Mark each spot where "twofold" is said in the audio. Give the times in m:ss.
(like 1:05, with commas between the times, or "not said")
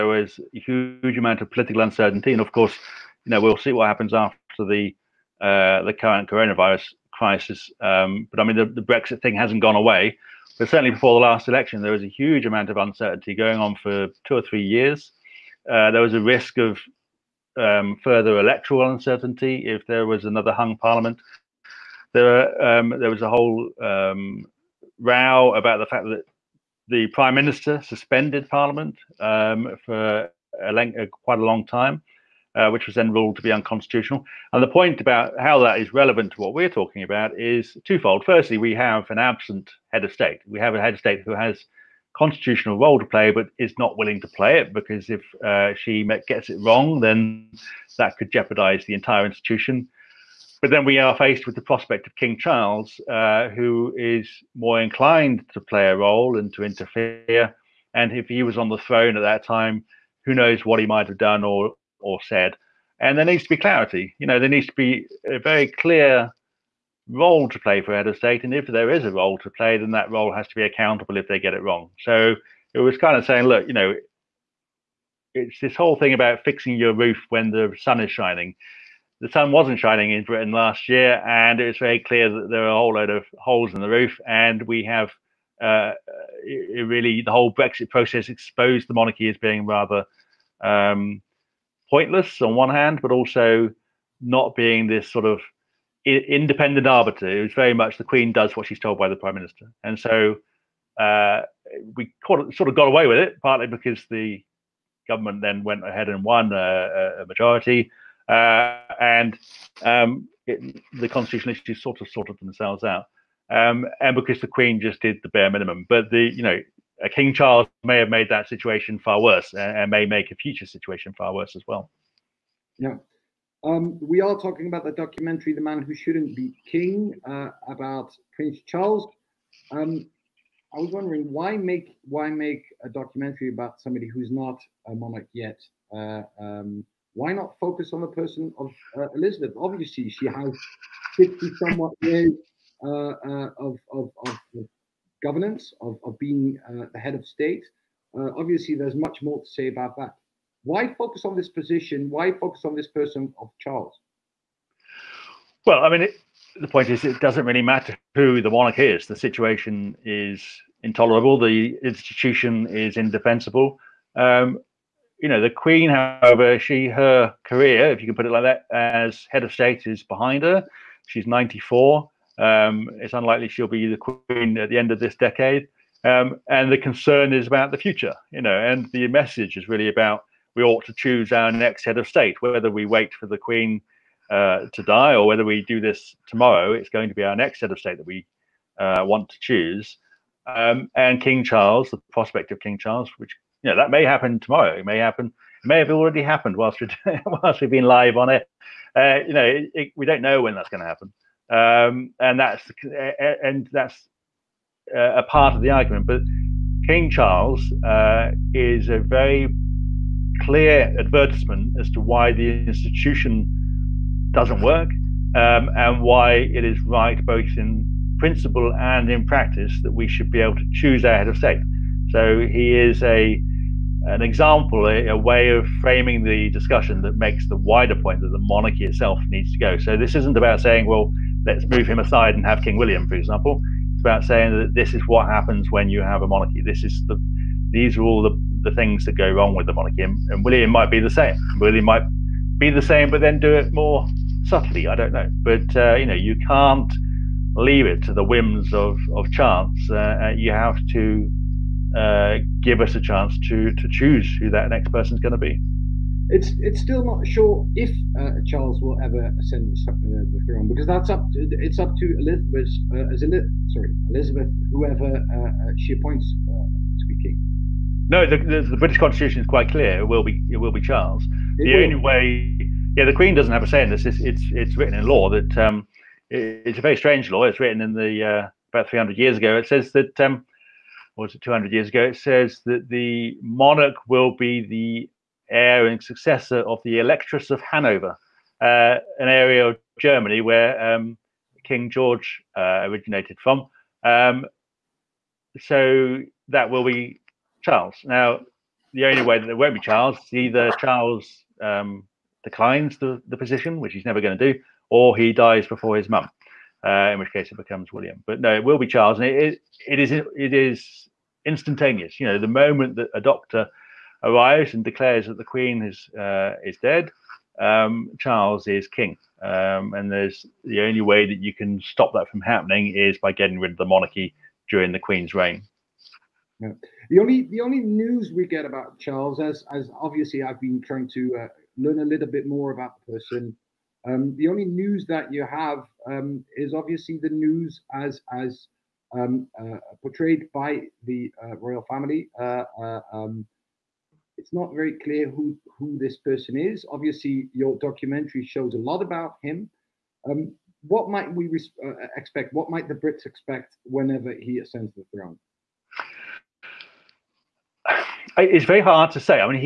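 0:37.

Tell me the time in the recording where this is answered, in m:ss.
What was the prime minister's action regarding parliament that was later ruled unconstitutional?
0:27.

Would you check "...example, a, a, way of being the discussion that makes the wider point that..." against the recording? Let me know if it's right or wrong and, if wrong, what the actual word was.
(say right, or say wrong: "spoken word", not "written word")
wrong: "framing", not "being".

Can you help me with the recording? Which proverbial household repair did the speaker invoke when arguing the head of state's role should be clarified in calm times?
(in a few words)
fixing your roof.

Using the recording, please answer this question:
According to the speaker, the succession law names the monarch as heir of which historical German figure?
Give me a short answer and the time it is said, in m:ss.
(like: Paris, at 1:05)
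Electress of Hanover, at 4:46.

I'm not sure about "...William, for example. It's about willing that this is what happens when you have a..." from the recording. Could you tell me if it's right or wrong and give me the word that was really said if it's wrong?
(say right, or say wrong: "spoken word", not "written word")
wrong: "saying", not "willing".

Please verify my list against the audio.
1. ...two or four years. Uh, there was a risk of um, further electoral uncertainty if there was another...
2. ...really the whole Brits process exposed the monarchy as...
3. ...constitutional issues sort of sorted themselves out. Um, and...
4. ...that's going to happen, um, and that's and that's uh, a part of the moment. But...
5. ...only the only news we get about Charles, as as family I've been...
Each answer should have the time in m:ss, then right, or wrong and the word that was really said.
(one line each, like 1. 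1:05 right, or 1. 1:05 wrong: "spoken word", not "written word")
1. 0:14 wrong: "three", not "four"
2. 1:26 wrong: "Brexit", not "Brits"
3. 1:51 right
4. 3:20 wrong: "argument", not "moment"
5. 5:27 wrong: "obviously", not "family".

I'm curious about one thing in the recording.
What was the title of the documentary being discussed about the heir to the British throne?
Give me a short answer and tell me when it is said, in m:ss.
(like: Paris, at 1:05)
The Man Who Shouldn't Be King, at 2:05.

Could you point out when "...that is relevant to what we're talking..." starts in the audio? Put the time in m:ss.
0:35.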